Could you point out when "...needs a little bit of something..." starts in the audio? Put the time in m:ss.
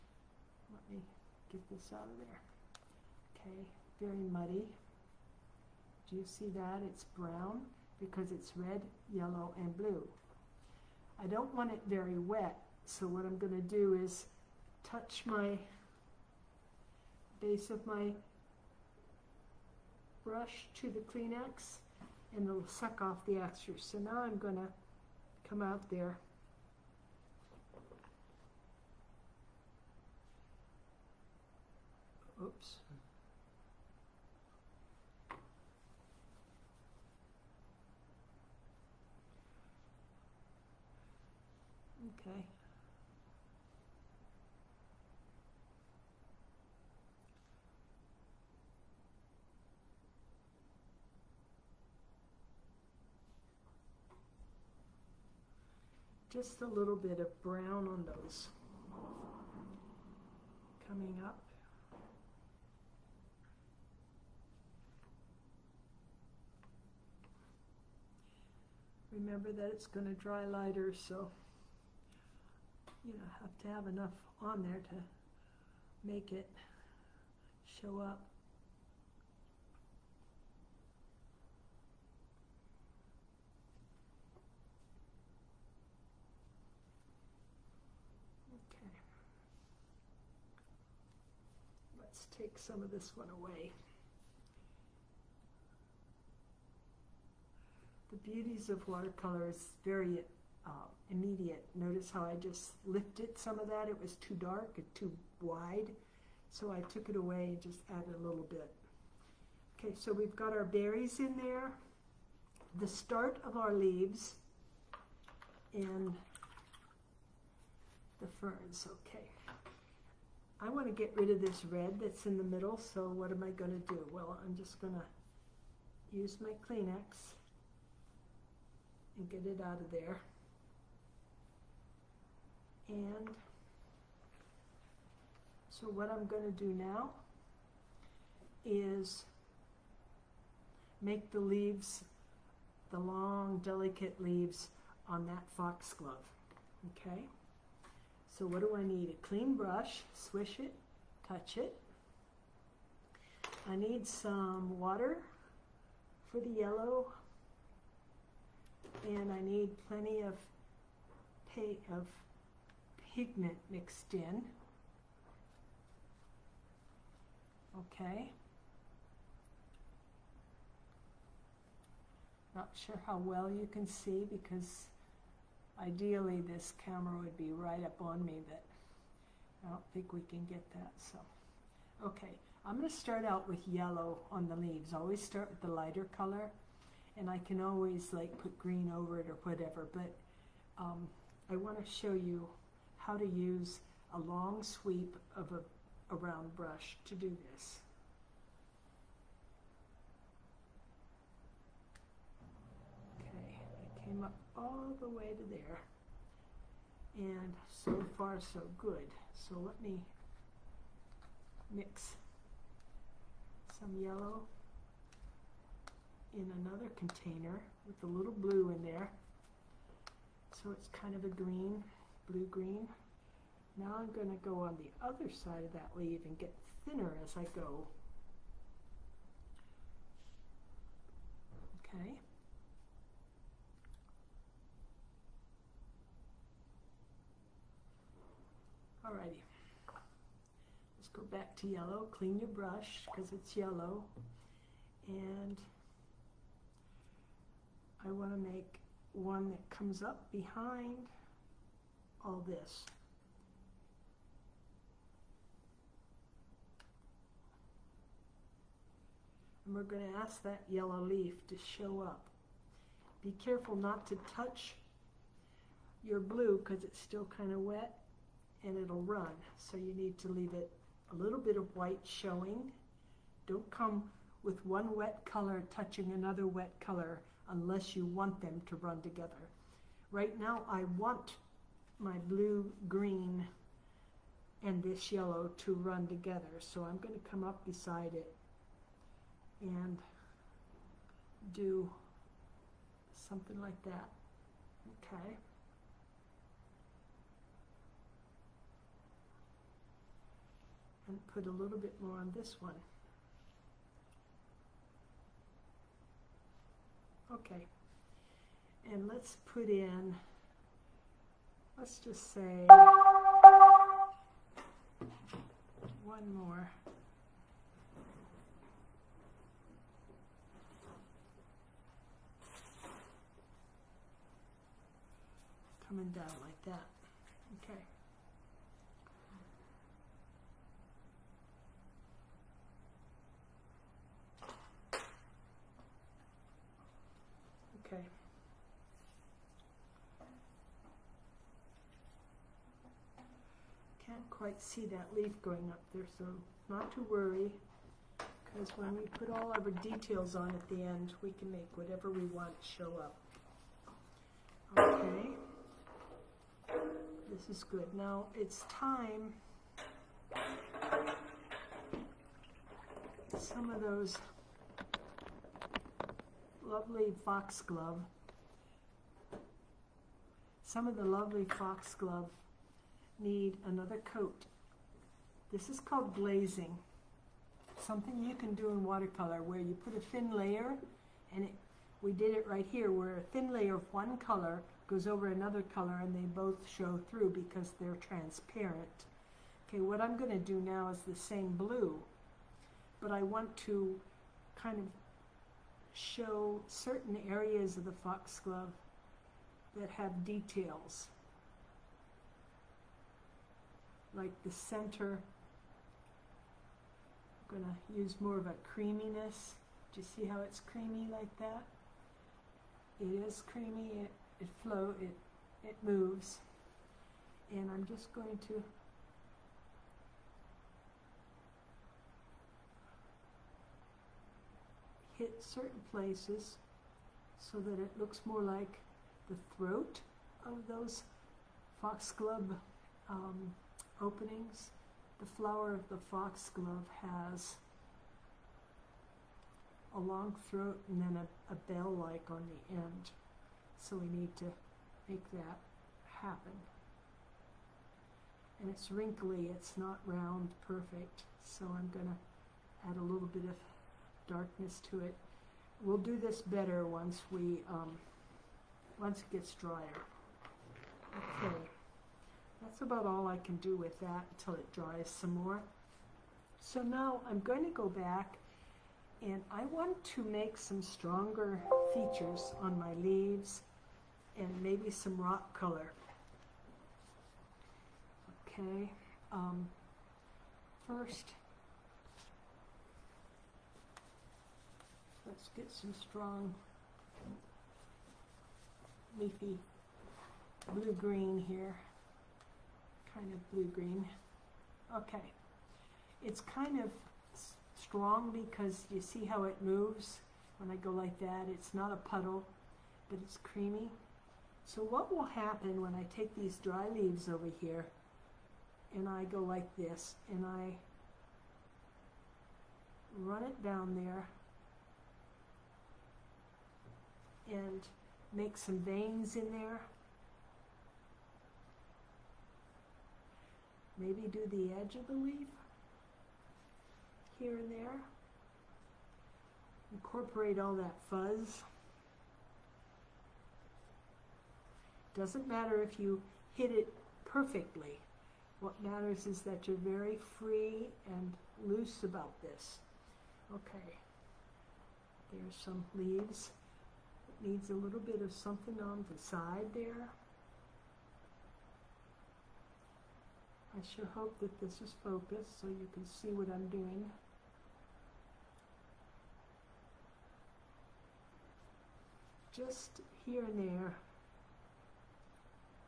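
9:07.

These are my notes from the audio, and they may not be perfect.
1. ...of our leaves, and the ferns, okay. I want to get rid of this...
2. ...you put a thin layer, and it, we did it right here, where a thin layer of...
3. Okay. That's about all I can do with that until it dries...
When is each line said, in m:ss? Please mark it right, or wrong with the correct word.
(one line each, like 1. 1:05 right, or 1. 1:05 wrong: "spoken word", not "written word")
1. 1:53 right
2. 6:19 right
3. 7:41 right.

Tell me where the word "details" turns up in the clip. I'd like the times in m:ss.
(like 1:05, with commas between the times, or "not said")
5:49, 6:40.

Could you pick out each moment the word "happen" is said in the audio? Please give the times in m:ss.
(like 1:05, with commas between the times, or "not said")
7:26, 8:25.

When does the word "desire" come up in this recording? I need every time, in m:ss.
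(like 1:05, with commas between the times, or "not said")
not said.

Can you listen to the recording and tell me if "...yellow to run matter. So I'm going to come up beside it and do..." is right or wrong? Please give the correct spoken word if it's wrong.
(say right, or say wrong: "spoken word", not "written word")
wrong: "together", not "matter".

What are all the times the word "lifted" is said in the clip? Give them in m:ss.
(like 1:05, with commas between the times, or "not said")
1:42.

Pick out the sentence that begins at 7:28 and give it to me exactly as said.
And it's wrinkly, it's not round perfect, so I'm going to add a little bit of darkness to it.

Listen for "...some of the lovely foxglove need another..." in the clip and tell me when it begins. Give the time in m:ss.
6:10.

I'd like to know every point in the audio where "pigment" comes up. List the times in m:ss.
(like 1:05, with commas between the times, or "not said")
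2:43.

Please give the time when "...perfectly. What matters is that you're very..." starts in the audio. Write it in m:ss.
8:57.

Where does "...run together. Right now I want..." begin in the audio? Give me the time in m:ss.
4:38.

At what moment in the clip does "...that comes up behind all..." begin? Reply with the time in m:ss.
4:09.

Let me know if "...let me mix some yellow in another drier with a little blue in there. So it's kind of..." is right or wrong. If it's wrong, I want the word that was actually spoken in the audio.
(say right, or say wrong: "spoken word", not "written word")
wrong: "container", not "drier".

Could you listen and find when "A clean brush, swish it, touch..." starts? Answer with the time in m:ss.
2:29.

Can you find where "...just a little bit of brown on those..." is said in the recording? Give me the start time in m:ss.
0:56.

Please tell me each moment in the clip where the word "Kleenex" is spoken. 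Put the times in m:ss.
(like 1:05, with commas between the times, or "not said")
0:21, 2:06.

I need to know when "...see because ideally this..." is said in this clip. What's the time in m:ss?
2:53.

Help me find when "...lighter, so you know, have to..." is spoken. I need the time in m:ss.
1:10.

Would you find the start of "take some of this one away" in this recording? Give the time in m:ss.
1:32.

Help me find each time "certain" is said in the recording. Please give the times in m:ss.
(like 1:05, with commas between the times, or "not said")
6:36, 7:05.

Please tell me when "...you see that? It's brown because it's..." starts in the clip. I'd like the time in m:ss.
0:06.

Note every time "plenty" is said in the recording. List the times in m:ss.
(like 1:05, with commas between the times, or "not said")
2:39.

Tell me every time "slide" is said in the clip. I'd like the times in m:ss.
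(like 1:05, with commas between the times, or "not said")
not said.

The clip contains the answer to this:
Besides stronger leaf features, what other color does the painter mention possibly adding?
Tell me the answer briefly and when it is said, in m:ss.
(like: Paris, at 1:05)
rock color, at 7:55.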